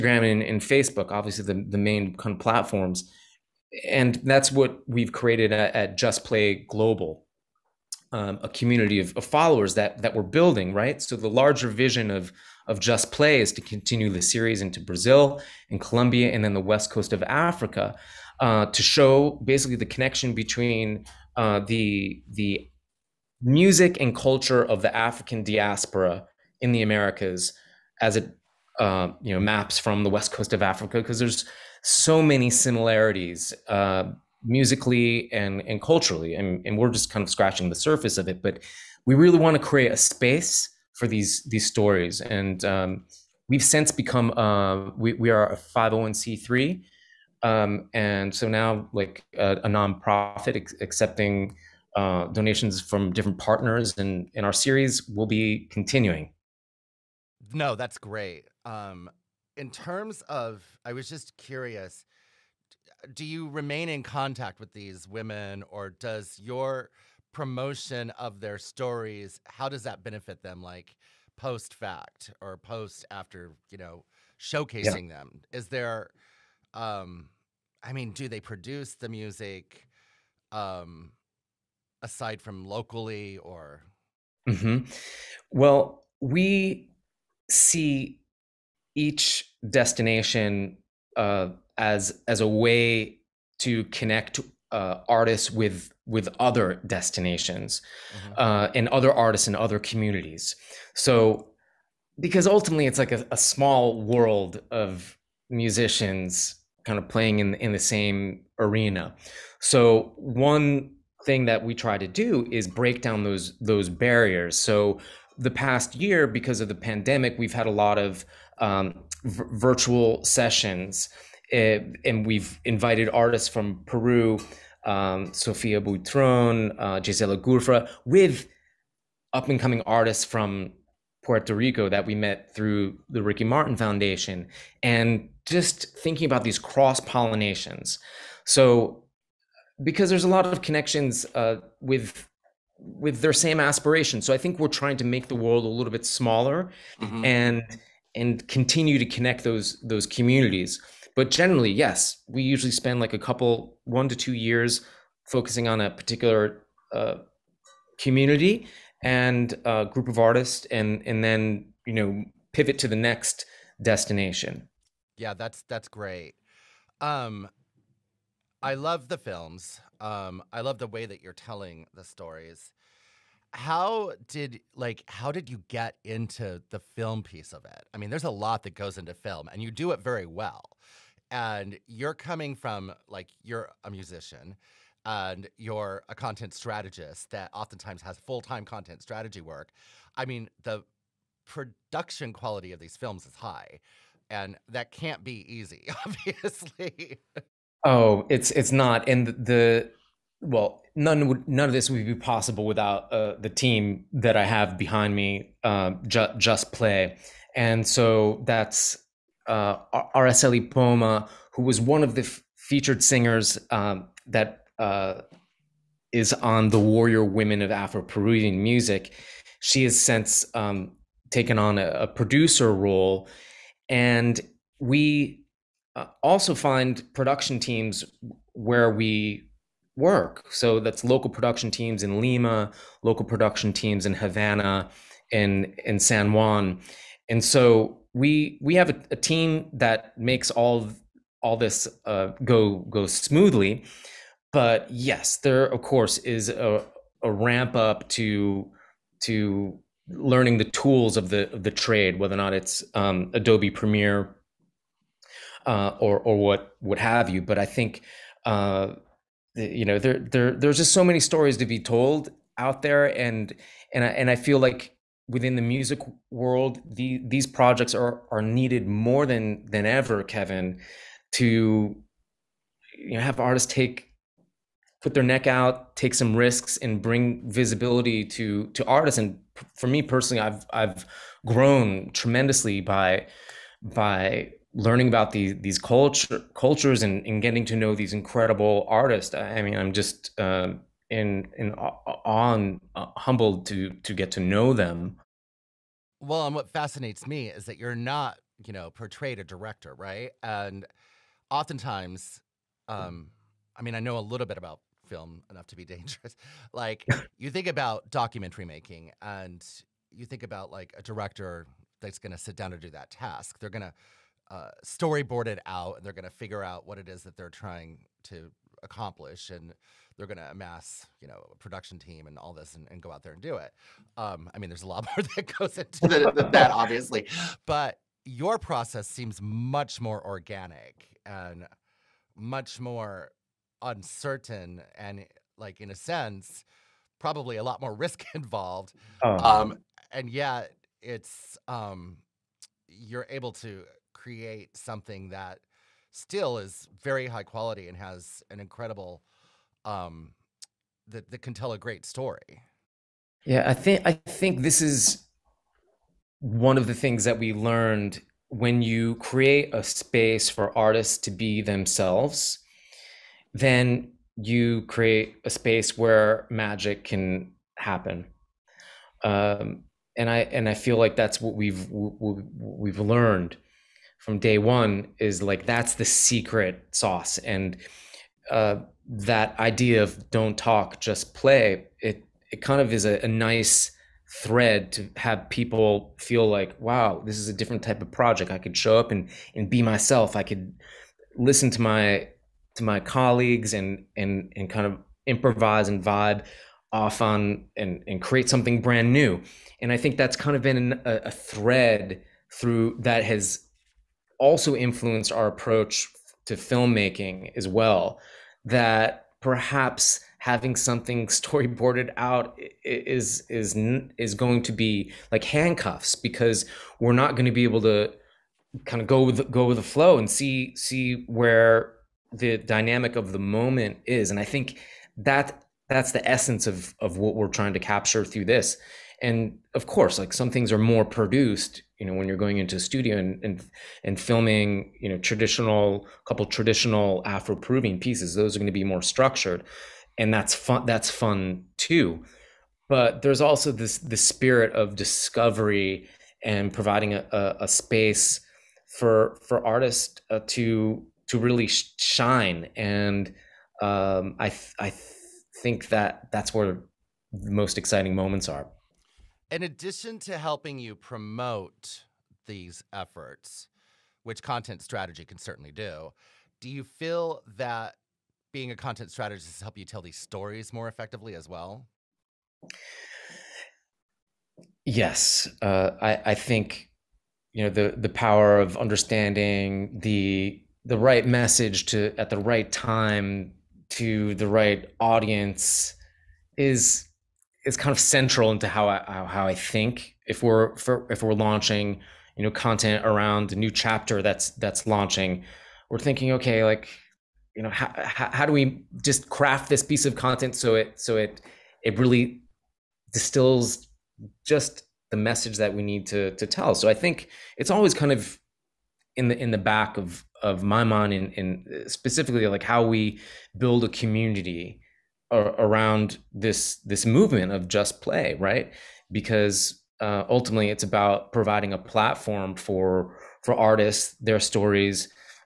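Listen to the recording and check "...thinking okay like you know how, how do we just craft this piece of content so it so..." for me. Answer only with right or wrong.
right.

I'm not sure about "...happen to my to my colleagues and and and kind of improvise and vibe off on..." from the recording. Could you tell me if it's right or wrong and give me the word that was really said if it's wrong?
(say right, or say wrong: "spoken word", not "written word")
wrong: "listen", not "happen".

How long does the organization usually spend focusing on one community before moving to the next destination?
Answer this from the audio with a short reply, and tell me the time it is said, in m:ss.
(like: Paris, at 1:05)
1 to 2 years, at 2:33.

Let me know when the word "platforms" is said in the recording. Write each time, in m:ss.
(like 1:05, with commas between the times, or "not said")
0:02, 8:41.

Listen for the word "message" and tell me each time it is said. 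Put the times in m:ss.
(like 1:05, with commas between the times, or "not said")
8:01, 8:25.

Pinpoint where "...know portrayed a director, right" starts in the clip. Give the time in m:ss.
4:58.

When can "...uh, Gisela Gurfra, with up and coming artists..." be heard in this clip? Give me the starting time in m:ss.
2:06.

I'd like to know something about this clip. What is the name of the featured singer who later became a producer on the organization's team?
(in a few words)
Araceli Poma.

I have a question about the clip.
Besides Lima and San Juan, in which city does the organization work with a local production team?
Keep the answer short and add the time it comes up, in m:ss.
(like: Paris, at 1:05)
Havana, at 3:54.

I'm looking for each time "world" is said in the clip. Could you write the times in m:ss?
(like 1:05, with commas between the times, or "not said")
1:44, 2:25, 4:26.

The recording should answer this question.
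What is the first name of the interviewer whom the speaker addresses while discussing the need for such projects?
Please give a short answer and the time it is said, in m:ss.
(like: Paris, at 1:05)
Kevin, at 4:30.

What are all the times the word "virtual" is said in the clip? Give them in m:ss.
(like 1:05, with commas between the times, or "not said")
1:59.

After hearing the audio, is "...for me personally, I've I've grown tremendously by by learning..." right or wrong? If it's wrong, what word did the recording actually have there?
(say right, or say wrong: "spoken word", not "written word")
right.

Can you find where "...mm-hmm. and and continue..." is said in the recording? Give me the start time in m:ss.
2:26.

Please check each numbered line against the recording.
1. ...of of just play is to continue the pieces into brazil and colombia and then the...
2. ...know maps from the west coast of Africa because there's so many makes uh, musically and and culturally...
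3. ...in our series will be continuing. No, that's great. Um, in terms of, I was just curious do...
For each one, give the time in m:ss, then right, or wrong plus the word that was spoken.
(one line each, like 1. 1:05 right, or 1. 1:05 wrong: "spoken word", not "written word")
1. 0:12 wrong: "series", not "pieces"
2. 0:29 wrong: "similarities", not "makes"
3. 0:54 right.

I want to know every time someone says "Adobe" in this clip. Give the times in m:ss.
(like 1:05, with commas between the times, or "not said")
4:13.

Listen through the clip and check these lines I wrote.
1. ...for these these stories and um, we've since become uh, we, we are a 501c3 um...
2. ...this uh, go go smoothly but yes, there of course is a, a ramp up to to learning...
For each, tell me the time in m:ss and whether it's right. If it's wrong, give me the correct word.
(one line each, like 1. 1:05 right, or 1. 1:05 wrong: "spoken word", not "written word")
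1. 0:40 right
2. 4:01 right.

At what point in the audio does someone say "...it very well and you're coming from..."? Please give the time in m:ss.
2:59.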